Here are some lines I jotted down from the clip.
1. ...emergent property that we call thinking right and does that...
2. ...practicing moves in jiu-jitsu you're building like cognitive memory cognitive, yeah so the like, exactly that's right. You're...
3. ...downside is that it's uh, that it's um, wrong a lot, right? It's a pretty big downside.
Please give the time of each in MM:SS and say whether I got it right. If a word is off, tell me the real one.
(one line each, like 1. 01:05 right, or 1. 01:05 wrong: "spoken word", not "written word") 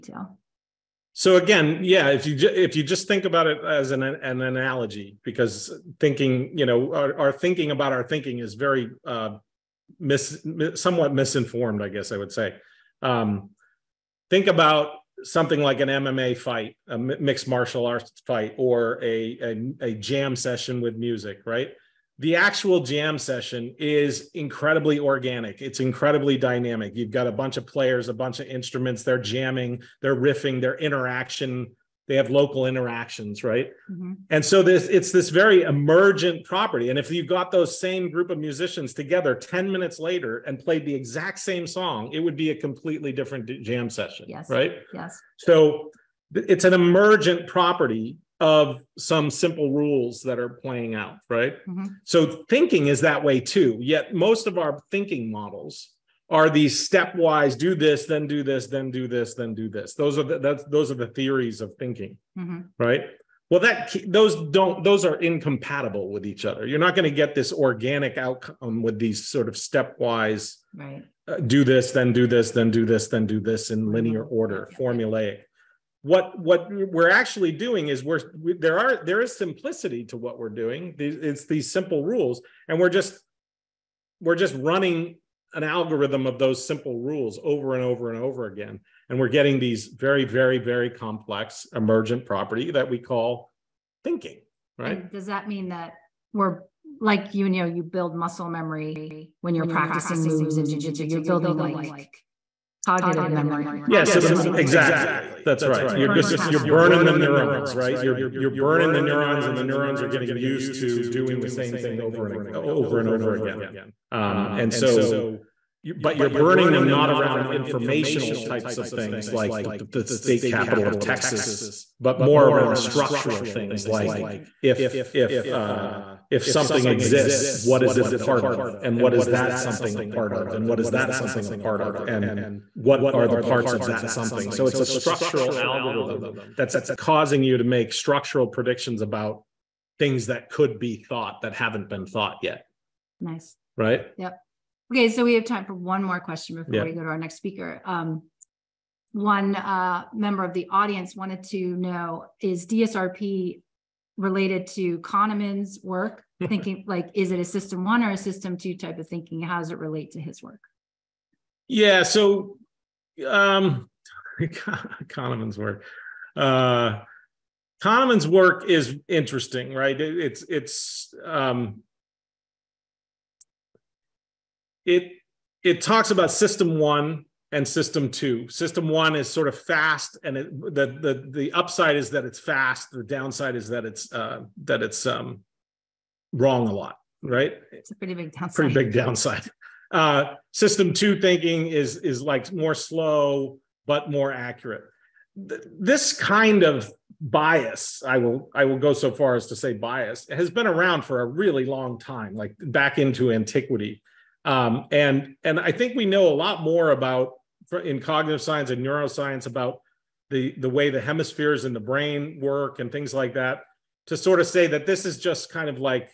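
1. 01:31 right
2. 01:39 right
3. 03:03 right.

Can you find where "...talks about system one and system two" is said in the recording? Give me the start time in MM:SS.
02:55.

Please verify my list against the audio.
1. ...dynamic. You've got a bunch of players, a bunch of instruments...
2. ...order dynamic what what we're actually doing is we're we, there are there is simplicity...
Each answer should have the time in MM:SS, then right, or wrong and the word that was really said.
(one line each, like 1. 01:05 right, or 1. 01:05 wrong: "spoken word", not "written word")
1. 00:26 right
2. 01:14 wrong: "formulaic", not "dynamic".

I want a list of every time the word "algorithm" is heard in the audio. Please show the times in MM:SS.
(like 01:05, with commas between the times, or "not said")
01:25, 02:15.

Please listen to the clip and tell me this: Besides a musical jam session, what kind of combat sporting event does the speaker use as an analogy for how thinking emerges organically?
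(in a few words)
MMA fight.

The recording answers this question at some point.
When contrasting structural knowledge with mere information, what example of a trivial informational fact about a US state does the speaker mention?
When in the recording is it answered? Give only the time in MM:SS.
01:59.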